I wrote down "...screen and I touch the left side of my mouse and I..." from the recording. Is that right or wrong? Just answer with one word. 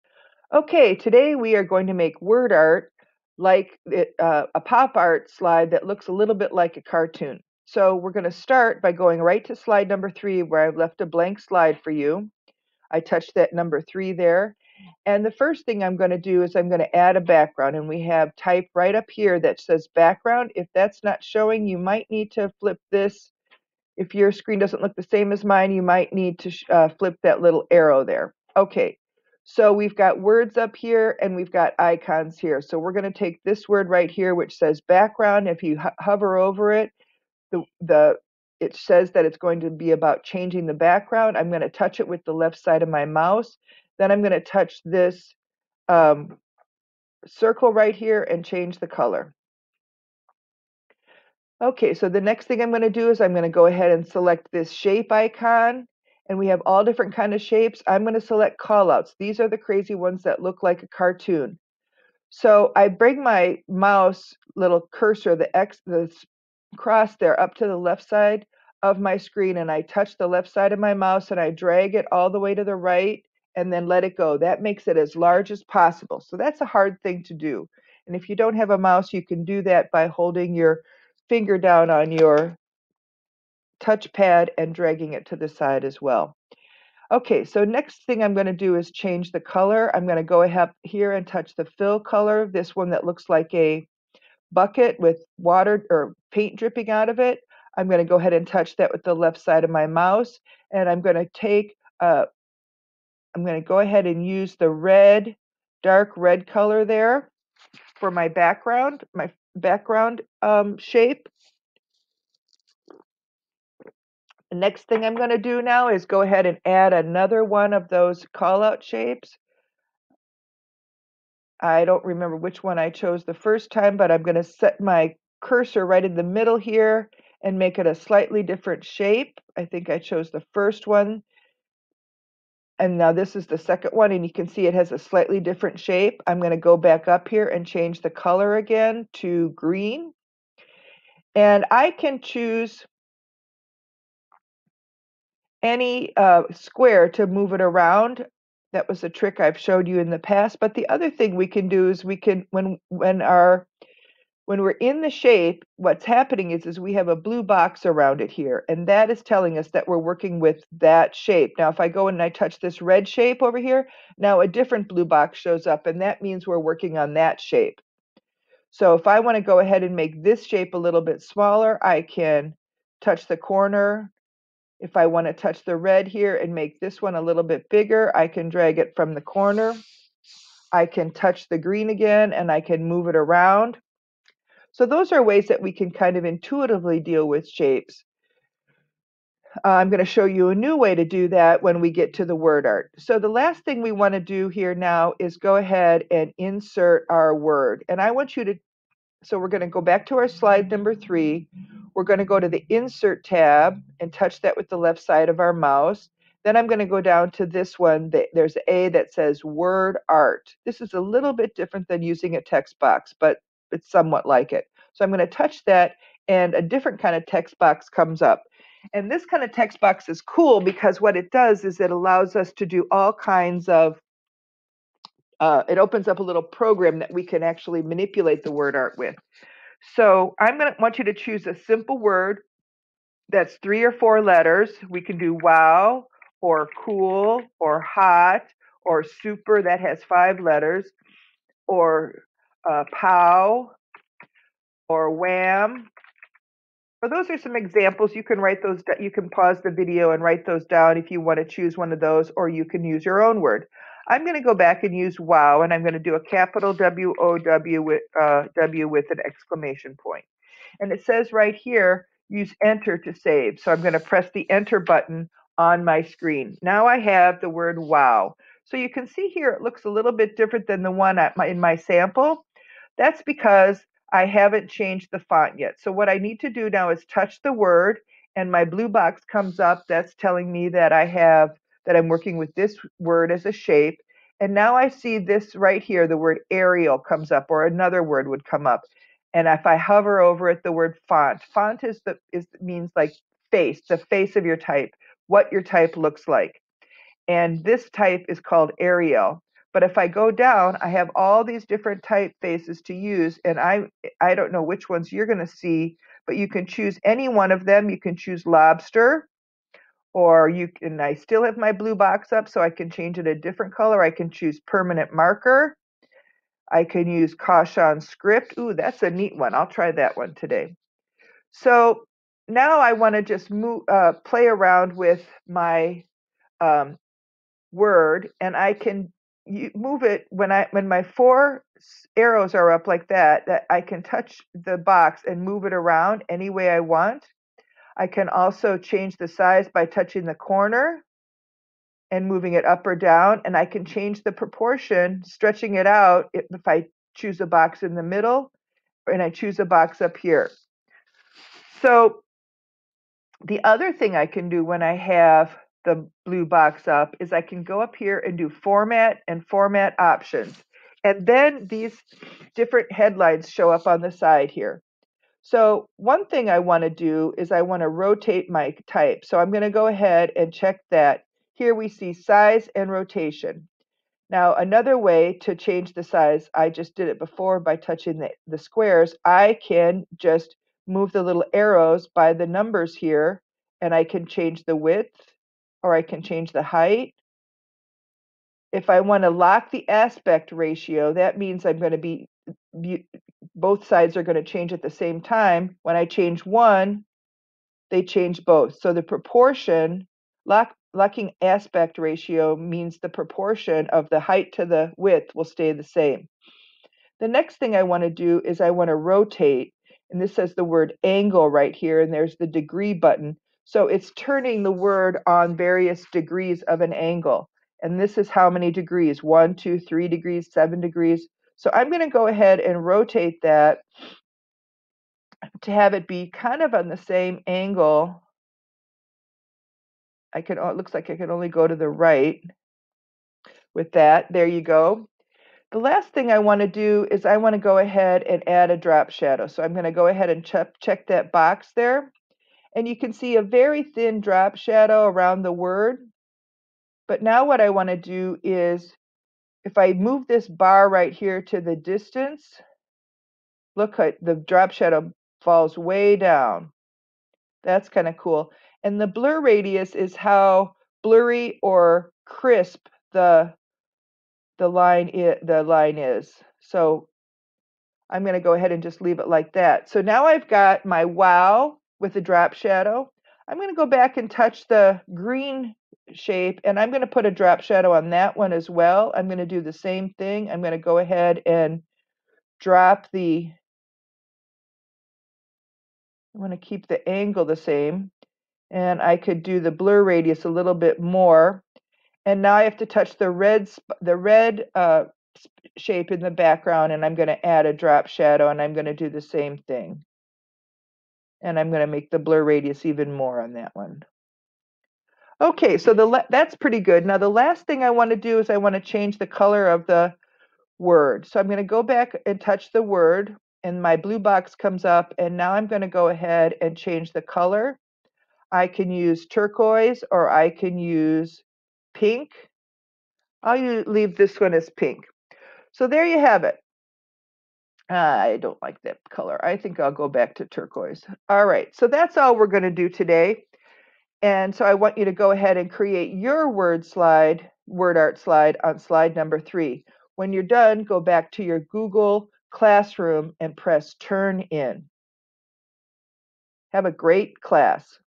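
right.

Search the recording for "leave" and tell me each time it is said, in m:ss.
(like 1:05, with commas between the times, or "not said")
7:49, 8:43.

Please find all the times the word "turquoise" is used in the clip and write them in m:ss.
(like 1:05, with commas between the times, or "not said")
8:39, 8:50.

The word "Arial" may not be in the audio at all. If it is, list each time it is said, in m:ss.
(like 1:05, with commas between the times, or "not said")
4:46, 4:58.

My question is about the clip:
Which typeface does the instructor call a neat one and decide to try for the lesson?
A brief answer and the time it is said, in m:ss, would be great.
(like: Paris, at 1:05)
Kaushan script, at 5:17.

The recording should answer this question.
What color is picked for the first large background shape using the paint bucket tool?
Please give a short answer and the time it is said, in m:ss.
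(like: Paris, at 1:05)
Dark red, at 1:45.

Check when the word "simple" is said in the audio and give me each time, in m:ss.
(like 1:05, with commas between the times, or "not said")
3:51.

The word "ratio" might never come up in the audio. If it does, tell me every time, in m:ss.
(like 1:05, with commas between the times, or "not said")
6:30, 6:41.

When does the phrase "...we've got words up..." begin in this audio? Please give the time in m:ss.
0:29.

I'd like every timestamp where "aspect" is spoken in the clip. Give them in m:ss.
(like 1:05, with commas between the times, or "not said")
6:29, 6:41.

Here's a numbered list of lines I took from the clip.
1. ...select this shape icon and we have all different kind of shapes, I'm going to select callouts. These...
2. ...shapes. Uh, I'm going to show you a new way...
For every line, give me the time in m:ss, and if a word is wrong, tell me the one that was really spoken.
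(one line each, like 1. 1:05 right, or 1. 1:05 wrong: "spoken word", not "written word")
1. 0:54 right
2. 3:07 right.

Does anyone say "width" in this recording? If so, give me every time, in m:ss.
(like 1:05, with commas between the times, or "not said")
6:24, 6:44.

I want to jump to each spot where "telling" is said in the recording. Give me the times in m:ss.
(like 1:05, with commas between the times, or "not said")
2:39, 4:40.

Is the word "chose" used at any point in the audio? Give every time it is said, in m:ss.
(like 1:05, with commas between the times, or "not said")
2:02, 2:09.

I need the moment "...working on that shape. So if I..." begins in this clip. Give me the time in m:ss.
2:46.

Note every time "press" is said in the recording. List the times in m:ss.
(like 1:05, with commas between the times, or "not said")
4:24, 9:03.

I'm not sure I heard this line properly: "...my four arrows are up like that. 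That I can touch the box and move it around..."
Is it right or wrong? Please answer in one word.
right.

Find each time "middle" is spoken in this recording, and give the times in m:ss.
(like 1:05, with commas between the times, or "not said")
2:06, 5:48.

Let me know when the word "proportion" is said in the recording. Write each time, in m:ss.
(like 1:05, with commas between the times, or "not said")
5:44, 6:39, 6:43.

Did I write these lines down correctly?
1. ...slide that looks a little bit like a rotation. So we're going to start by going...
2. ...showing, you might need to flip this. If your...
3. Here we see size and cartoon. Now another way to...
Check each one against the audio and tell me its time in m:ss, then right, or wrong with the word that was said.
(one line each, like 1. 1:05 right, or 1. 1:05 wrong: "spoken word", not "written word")
1. 0:05 wrong: "cartoon", not "rotation"
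2. 0:21 right
3. 6:11 wrong: "rotation", not "cartoon".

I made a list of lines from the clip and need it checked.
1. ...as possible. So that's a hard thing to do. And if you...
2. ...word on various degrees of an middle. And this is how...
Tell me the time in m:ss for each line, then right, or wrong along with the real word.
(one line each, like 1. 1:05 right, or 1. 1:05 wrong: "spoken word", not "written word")
1. 1:15 right
2. 6:54 wrong: "angle", not "middle".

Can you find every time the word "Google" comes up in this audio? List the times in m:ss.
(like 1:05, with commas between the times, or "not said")
9:01.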